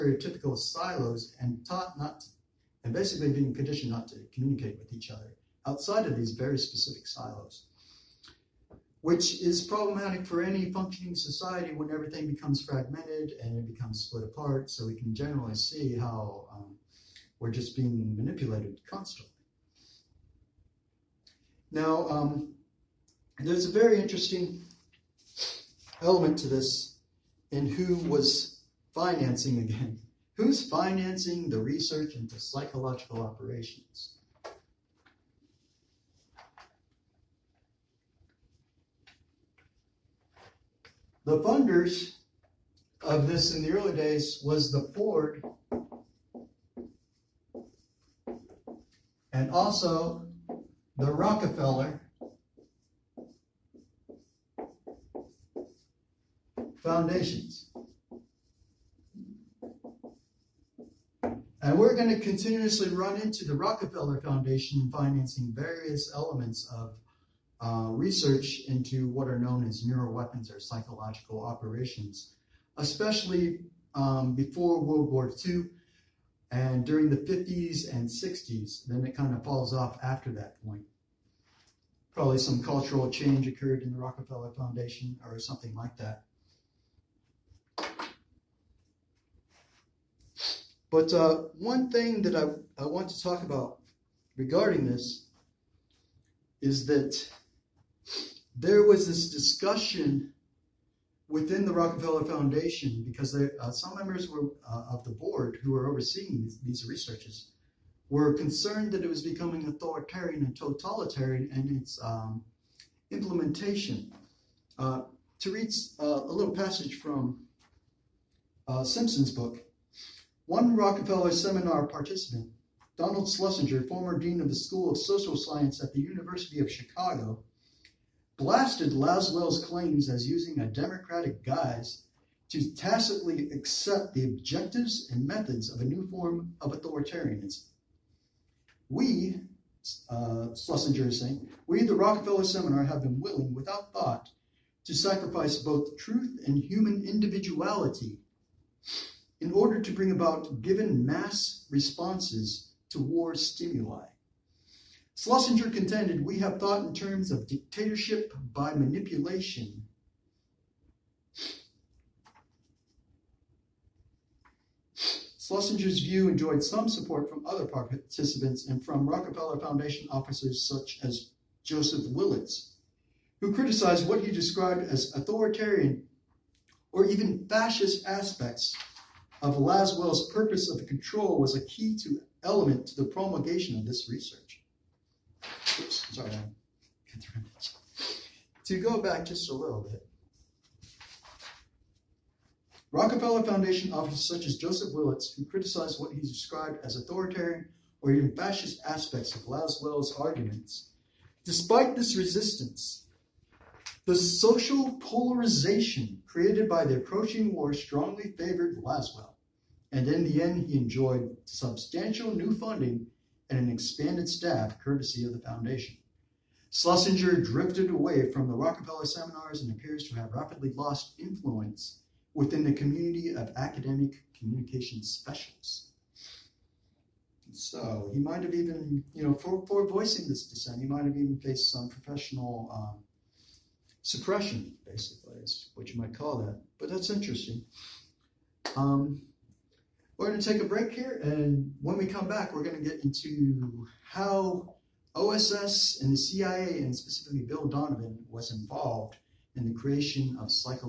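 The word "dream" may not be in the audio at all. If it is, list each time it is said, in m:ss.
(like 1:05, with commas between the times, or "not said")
not said.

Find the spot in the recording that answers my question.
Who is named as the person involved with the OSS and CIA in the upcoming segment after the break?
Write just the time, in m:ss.
4:07.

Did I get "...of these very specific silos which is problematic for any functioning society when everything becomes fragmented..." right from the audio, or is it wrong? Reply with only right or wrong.
right.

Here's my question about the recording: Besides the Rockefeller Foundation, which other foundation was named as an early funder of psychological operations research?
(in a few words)
Ford.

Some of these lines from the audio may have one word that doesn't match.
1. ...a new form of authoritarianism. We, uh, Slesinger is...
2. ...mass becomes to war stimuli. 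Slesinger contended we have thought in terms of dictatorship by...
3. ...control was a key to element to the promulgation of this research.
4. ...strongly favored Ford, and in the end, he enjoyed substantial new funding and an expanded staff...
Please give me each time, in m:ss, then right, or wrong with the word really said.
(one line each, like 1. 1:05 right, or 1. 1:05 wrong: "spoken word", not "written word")
1. 2:15 right
2. 2:31 wrong: "responses", not "becomes"
3. 3:00 right
4. 3:27 wrong: "Lasswell", not "Ford".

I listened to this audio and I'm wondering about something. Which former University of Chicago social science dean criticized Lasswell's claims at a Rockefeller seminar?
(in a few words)
Donald Slesinger.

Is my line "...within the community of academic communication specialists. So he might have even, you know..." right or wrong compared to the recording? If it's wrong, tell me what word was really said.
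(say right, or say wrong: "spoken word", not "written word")
right.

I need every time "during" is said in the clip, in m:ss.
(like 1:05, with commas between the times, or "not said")
1:16.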